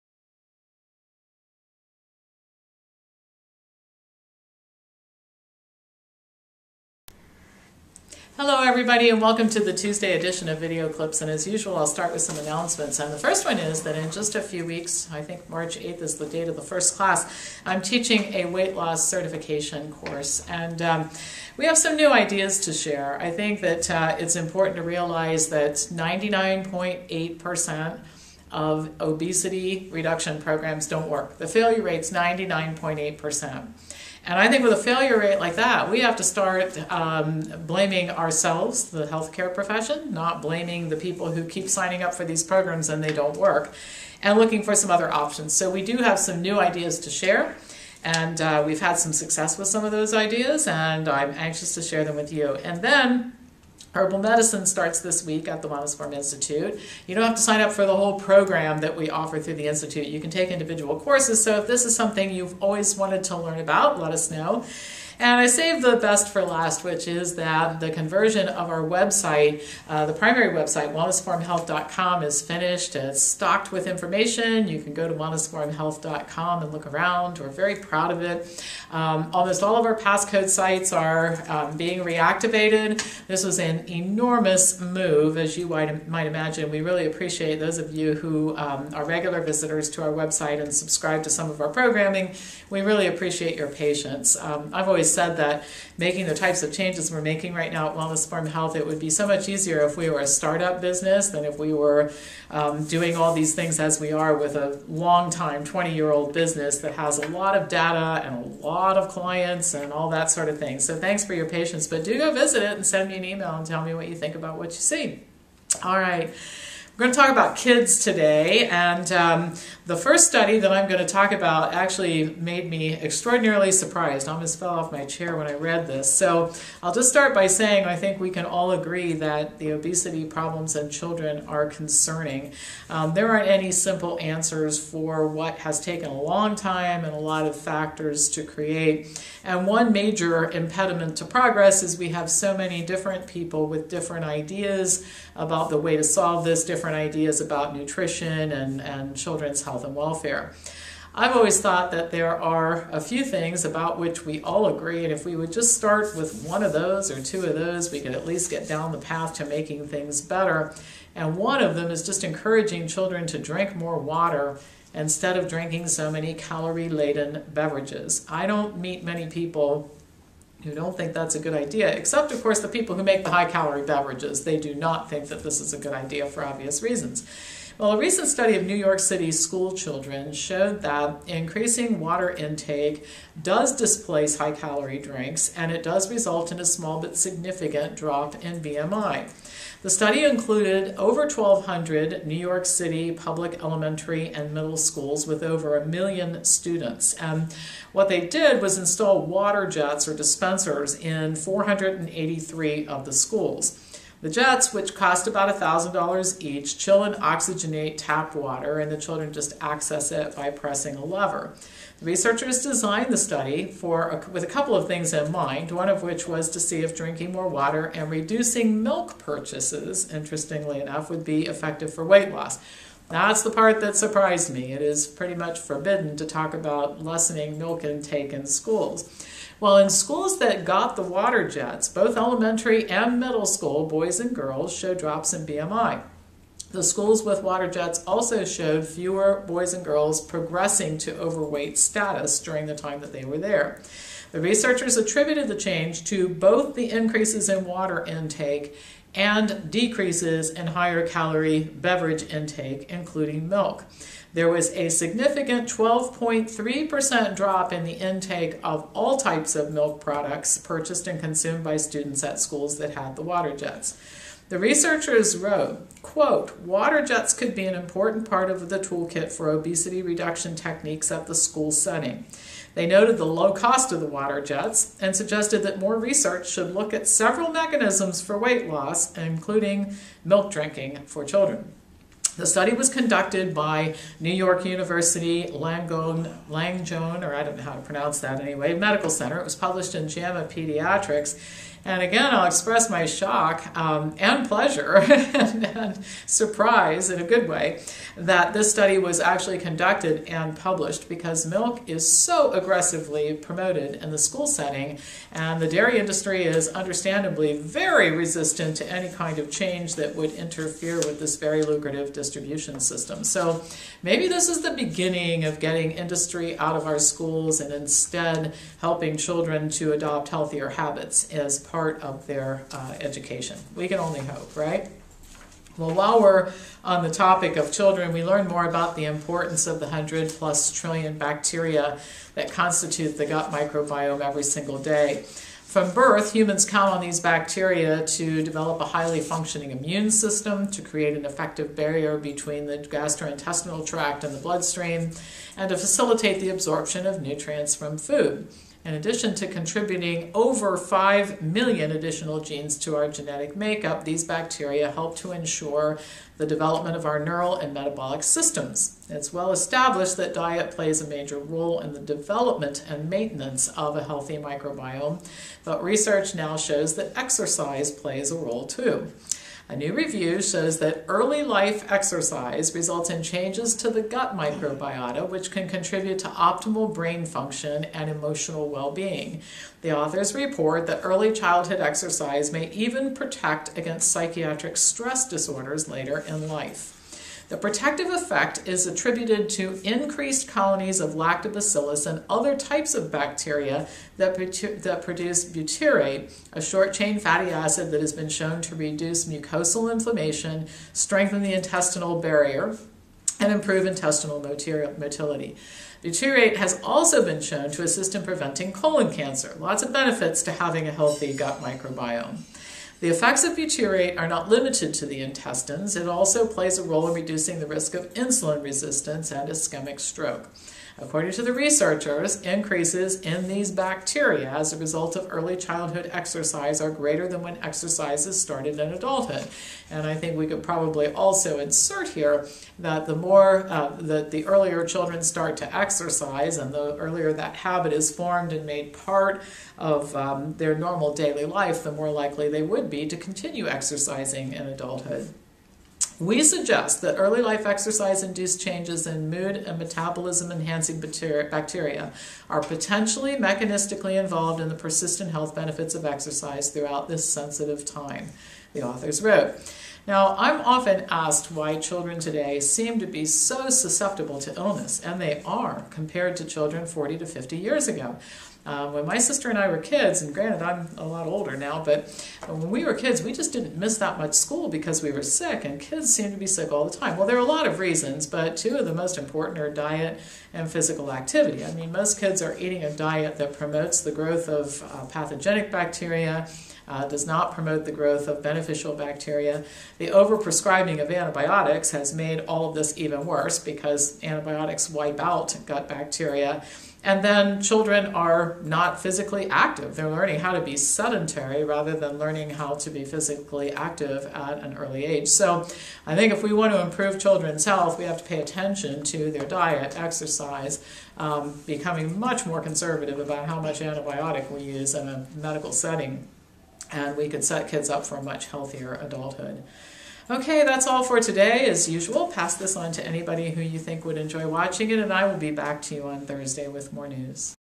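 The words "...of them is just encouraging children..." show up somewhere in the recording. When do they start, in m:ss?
2:41.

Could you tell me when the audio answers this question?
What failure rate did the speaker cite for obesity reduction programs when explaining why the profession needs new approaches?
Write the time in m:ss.
0:31.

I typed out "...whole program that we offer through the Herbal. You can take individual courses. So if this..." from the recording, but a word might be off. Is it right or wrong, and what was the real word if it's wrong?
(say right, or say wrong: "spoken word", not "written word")
wrong: "Institute", not "Herbal".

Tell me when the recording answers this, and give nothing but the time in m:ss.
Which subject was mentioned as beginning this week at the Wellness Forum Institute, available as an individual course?
0:53.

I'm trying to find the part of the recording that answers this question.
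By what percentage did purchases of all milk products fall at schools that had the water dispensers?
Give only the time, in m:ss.
4:15.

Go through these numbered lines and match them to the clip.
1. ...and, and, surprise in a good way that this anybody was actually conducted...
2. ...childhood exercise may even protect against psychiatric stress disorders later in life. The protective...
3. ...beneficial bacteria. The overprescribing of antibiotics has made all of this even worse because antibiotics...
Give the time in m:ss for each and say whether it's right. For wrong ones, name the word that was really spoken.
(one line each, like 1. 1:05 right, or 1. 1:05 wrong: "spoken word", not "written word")
1. 4:54 wrong: "study", not "anybody"
2. 6:21 right
3. 8:08 right.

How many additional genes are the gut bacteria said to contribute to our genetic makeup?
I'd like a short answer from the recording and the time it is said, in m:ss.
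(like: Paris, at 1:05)
5 million, at 5:50.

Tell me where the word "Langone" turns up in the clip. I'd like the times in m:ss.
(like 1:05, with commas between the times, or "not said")
4:45.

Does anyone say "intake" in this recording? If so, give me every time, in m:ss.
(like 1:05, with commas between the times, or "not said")
3:02, 3:47, 4:08, 4:12, 4:17.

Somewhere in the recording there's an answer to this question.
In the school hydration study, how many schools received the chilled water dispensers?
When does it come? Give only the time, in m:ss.
3:21.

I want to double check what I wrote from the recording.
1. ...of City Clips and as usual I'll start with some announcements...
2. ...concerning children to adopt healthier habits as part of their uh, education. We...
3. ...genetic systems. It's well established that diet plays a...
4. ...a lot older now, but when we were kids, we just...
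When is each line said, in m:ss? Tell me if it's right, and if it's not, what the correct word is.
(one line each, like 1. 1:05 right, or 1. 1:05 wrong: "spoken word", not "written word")
1. 0:10 wrong: "Video", not "City"
2. 5:18 wrong: "helping", not "concerning"
3. 5:57 wrong: "metabolic", not "genetic"
4. 7:50 right.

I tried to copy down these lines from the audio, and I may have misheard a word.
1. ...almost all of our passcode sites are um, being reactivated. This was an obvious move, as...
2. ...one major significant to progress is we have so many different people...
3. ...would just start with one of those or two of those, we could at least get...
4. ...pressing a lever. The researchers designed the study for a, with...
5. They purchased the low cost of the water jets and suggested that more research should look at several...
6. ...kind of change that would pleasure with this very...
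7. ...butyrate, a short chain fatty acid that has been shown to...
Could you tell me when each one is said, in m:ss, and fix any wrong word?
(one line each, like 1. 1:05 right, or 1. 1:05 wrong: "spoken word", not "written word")
1. 1:19 wrong: "enormous", not "obvious"
2. 2:19 wrong: "impediment", not "significant"
3. 2:35 right
4. 3:30 right
5. 4:32 wrong: "noted", not "purchased"
6. 5:09 wrong: "interfere", not "pleasure"
7. 6:35 right.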